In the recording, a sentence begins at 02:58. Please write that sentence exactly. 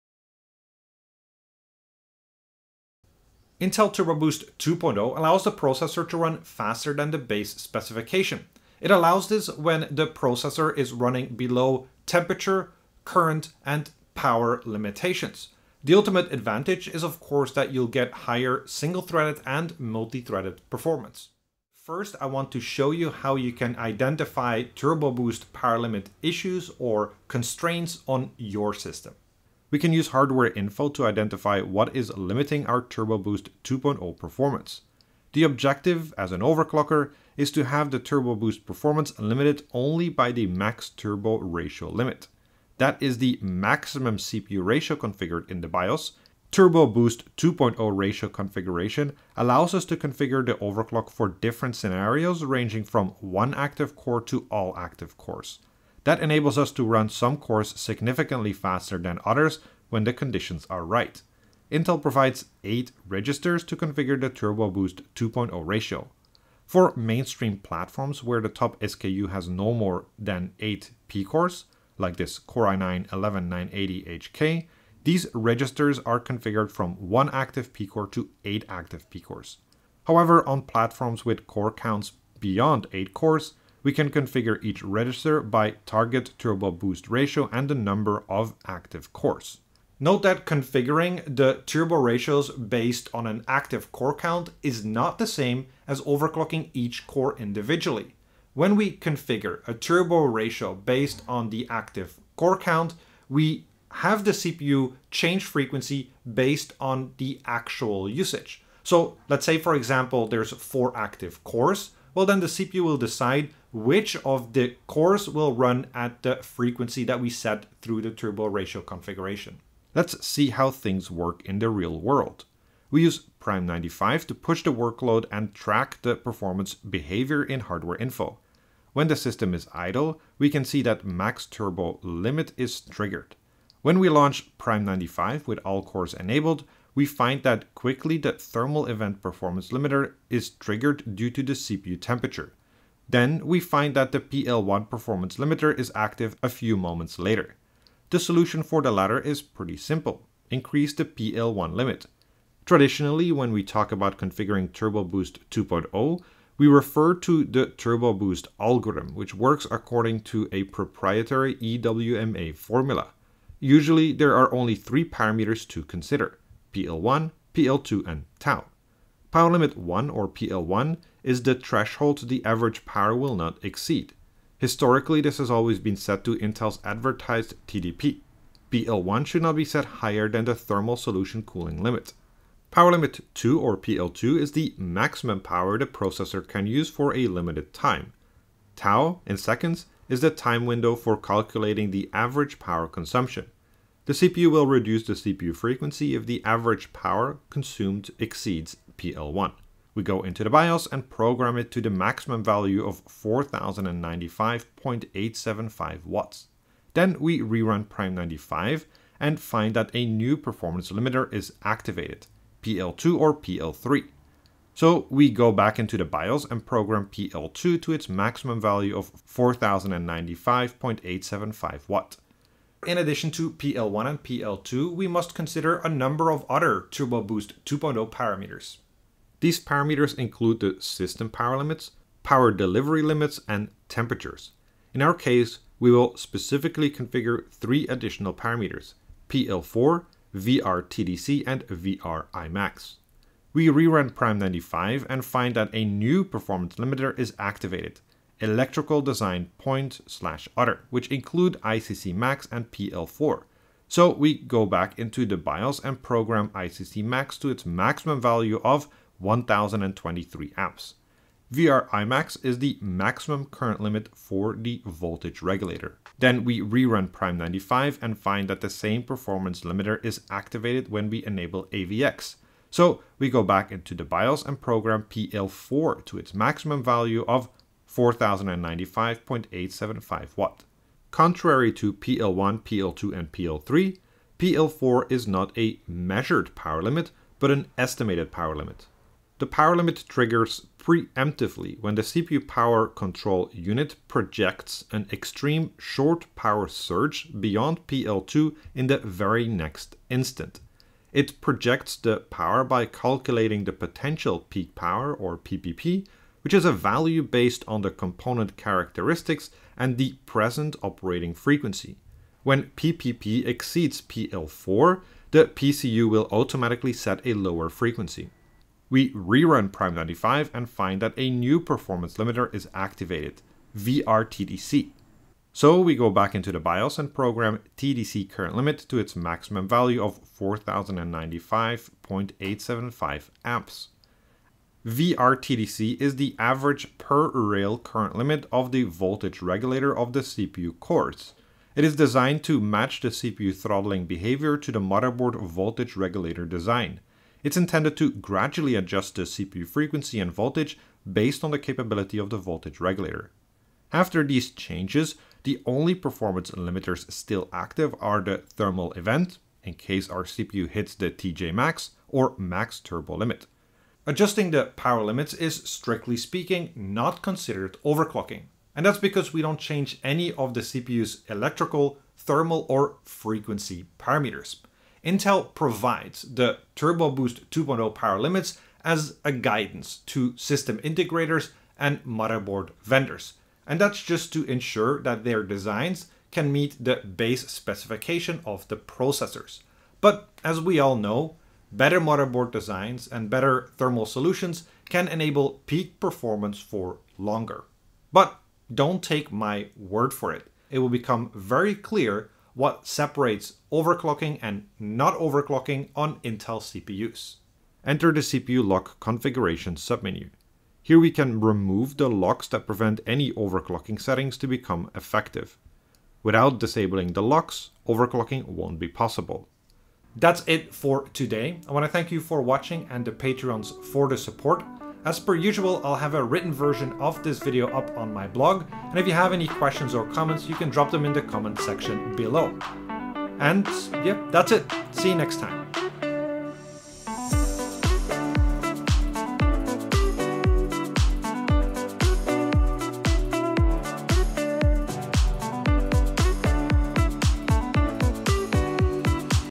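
PL1 should not be set higher than the thermal solution cooling limit.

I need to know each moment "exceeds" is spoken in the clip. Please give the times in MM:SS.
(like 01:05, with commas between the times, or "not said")
02:53, 03:18, 05:13.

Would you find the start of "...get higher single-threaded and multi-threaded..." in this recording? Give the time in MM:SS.
00:17.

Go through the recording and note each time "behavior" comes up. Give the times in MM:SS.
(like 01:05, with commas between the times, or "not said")
02:06, 05:44.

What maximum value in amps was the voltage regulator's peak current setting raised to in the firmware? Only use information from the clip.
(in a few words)
1023 amps.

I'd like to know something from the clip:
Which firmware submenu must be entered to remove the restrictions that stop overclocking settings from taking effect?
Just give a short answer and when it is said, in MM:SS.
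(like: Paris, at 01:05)
CPU lock configuration, at 06:48.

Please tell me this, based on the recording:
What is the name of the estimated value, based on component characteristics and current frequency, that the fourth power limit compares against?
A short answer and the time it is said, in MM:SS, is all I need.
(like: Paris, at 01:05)
potential peak power, at 05:03.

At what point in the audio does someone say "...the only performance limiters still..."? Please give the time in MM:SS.
05:55.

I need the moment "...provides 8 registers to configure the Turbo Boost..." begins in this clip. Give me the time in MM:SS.
01:02.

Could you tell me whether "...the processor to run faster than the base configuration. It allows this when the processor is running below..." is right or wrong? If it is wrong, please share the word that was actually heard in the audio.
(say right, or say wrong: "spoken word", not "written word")
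wrong: "specification", not "configuration".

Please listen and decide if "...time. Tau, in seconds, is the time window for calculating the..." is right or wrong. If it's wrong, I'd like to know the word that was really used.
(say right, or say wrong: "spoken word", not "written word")
right.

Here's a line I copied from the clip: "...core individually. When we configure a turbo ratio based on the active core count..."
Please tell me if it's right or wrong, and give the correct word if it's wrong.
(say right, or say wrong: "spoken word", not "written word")
right.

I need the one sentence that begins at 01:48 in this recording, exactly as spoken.
So let's say, for example, there's four active cores.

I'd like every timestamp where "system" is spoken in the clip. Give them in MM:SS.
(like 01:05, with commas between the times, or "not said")
00:28, 02:09, 03:50, 06:20.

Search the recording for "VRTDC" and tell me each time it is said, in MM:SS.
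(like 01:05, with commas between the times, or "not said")
04:00, 05:23, 05:34.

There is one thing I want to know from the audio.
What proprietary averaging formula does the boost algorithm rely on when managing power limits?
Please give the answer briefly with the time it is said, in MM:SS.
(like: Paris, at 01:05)
EWMA, at 02:41.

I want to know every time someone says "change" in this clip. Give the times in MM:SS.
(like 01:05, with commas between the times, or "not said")
01:45, 05:54, 06:09.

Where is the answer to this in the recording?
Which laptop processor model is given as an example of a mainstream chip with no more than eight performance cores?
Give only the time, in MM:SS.
01:12.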